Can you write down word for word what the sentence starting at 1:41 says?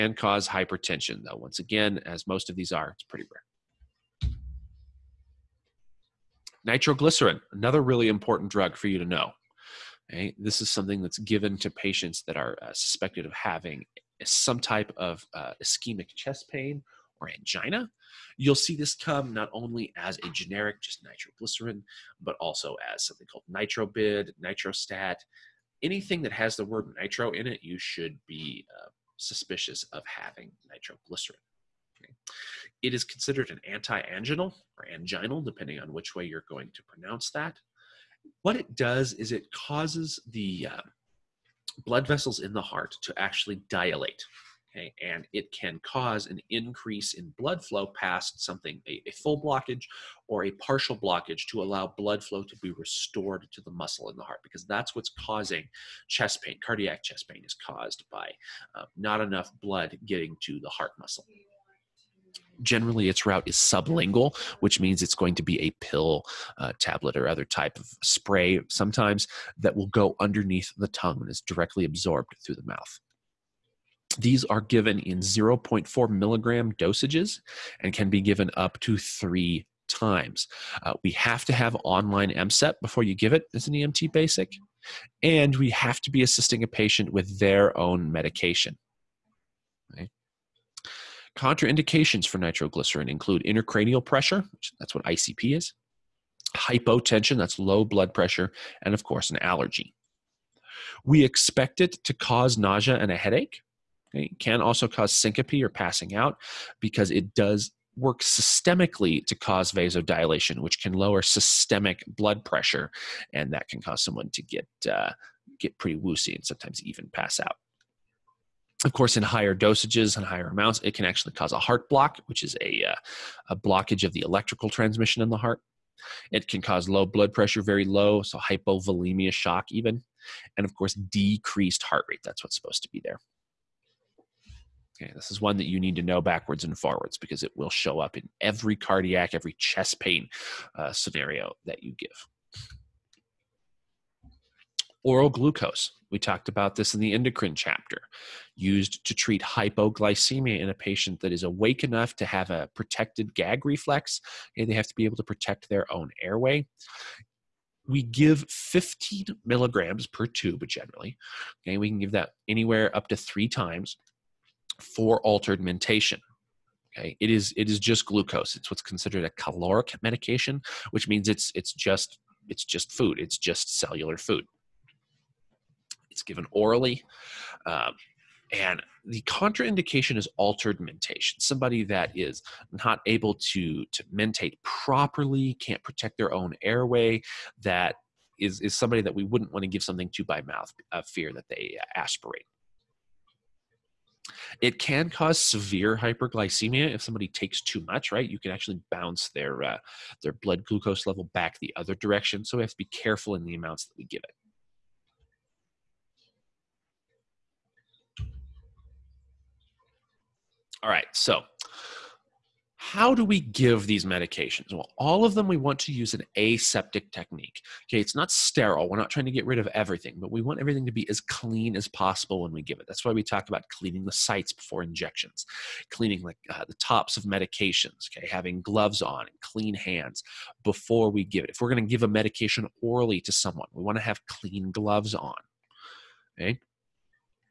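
We expect it to cause nausea and a headache.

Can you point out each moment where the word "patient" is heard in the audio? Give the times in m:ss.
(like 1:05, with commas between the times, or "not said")
0:11, 1:26, 2:30.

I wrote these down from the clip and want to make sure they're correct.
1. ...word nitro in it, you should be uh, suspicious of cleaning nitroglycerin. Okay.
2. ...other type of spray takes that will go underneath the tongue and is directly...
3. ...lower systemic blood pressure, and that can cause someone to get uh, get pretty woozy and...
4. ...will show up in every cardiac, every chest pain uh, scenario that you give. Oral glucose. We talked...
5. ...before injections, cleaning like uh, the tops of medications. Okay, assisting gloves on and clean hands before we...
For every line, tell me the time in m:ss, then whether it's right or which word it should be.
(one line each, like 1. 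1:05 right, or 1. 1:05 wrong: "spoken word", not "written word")
1. 0:26 wrong: "having", not "cleaning"
2. 1:07 wrong: "sometimes", not "takes"
3. 1:50 right
4. 2:17 right
5. 3:44 wrong: "having", not "assisting".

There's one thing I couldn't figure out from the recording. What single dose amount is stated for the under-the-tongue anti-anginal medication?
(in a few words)
0.4 milligrams.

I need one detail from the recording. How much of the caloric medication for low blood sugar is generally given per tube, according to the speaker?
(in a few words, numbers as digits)
15 milligrams.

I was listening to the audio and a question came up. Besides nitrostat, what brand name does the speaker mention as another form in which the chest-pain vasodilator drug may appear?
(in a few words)
Nitrobid.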